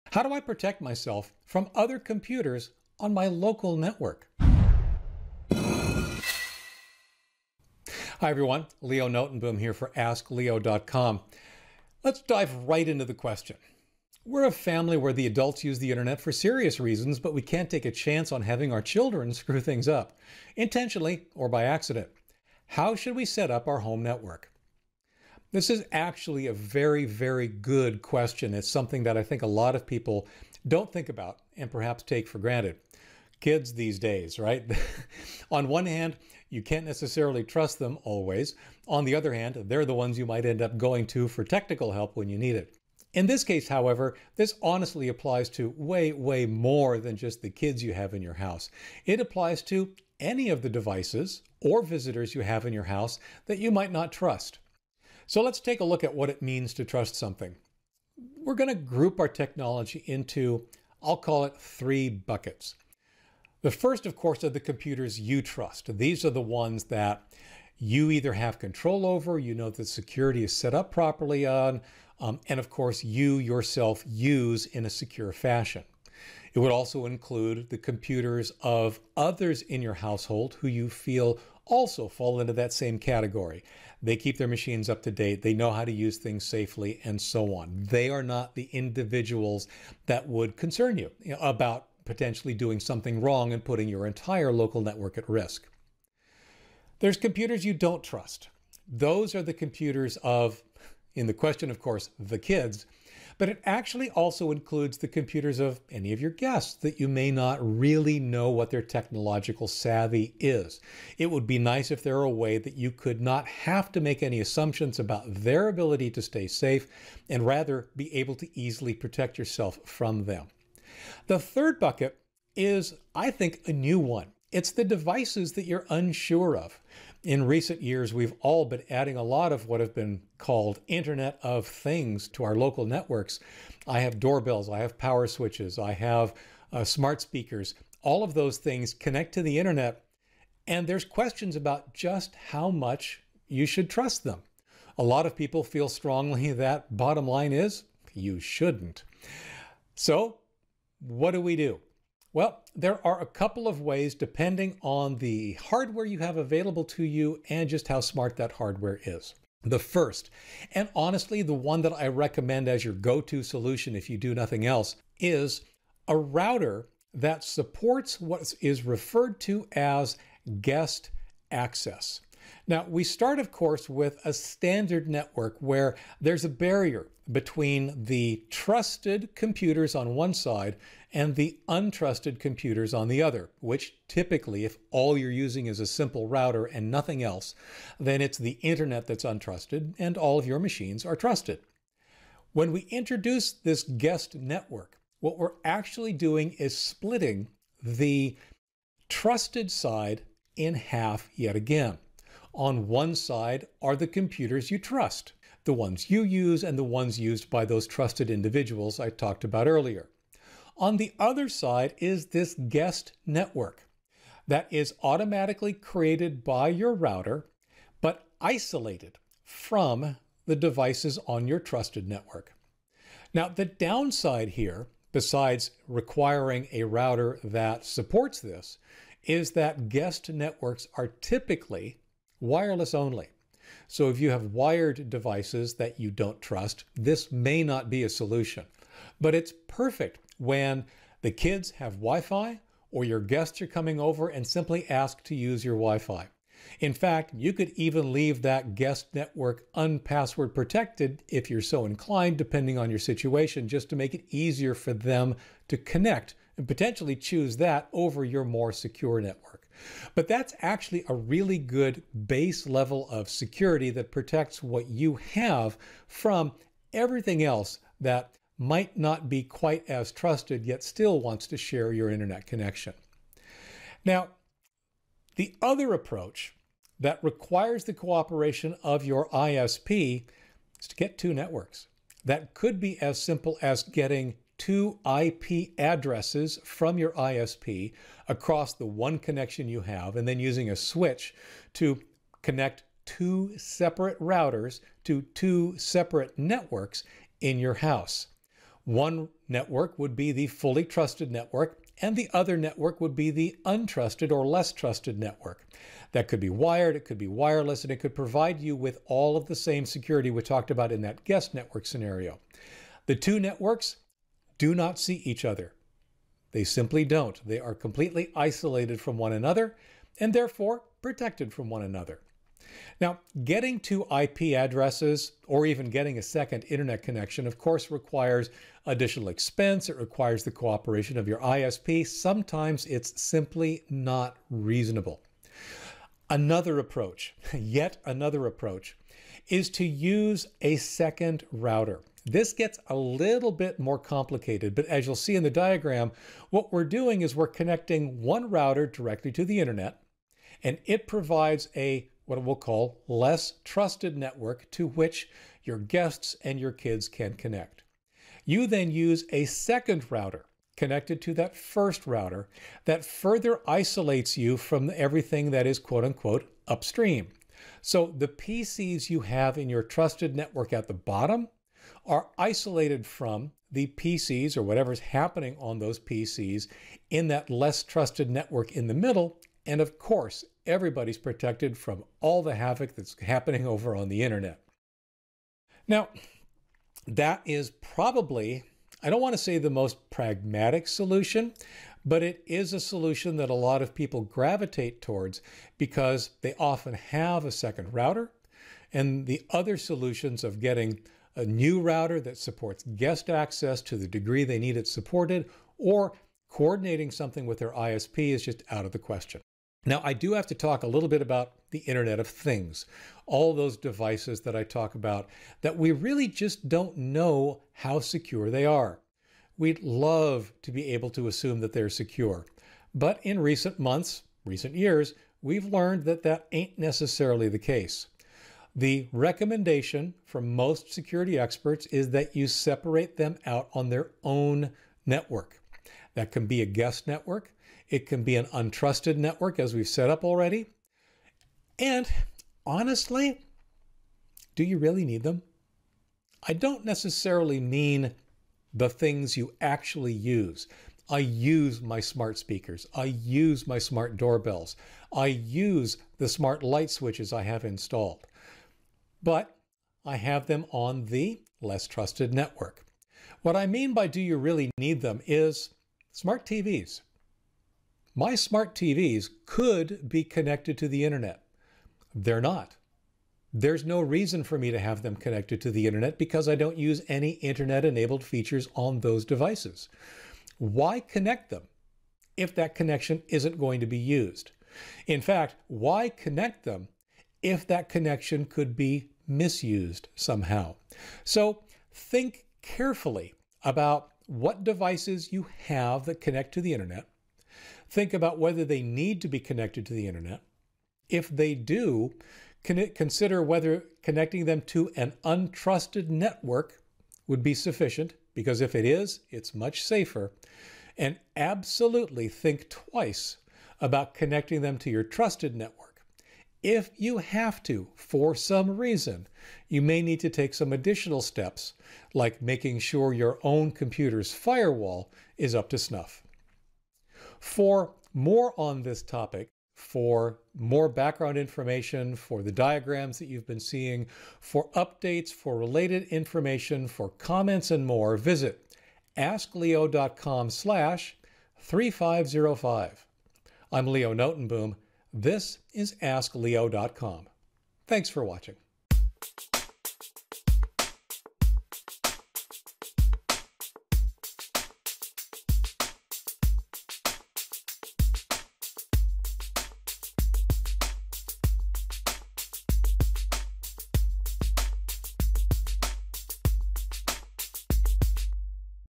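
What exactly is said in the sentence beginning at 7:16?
That can be a guest network, it can be an untrusted network, as we've set up already.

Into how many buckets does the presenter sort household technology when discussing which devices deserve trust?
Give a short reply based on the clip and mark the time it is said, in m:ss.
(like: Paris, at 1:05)
3, at 1:01.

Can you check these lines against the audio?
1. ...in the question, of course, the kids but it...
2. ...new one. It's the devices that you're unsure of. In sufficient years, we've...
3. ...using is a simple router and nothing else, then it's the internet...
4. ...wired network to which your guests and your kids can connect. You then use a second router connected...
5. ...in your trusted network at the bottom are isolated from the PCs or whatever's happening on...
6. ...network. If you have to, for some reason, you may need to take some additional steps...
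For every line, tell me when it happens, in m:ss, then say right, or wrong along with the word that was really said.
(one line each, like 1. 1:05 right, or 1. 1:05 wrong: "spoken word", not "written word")
1. 1:41 right
2. 2:03 wrong: "recent", not "sufficient"
3. 3:05 right
4. 5:53 wrong: "trusted", not "wired"
5. 6:09 right
6. 8:35 right.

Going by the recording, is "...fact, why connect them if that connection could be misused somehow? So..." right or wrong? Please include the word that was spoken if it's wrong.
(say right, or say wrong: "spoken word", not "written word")
right.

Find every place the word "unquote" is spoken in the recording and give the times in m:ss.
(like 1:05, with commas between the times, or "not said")
6:06.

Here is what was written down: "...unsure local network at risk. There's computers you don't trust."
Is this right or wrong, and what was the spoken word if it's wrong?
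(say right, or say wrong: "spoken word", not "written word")
wrong: "entire", not "unsure".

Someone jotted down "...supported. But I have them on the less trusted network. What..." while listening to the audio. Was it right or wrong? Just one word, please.
wrong.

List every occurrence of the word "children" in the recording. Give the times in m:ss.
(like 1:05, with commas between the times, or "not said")
0:18.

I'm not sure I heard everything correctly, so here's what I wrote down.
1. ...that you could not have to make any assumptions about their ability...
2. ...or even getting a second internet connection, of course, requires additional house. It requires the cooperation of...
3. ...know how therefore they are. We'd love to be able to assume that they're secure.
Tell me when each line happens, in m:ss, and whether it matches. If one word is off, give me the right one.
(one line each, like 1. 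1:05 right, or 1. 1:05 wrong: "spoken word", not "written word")
1. 1:52 right
2. 5:25 wrong: "expense", not "house"
3. 6:56 wrong: "secure", not "therefore".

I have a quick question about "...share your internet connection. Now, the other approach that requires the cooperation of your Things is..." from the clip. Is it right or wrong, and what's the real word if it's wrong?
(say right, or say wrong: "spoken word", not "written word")
wrong: "ISP", not "Things".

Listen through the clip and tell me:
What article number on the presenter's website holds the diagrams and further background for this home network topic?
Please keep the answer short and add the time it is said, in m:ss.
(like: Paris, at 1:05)
3505, at 9:01.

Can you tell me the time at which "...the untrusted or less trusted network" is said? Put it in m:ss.
5:03.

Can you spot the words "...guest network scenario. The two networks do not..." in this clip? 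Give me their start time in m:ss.
5:11.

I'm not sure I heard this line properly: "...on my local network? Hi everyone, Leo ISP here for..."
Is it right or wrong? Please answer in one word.
wrong.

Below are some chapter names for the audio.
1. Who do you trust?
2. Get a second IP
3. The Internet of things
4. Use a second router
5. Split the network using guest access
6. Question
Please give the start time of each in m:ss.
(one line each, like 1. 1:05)
1. 0:56
2. 4:42
3. 6:47
4. 5:41
5. 2:47
6. 0:14.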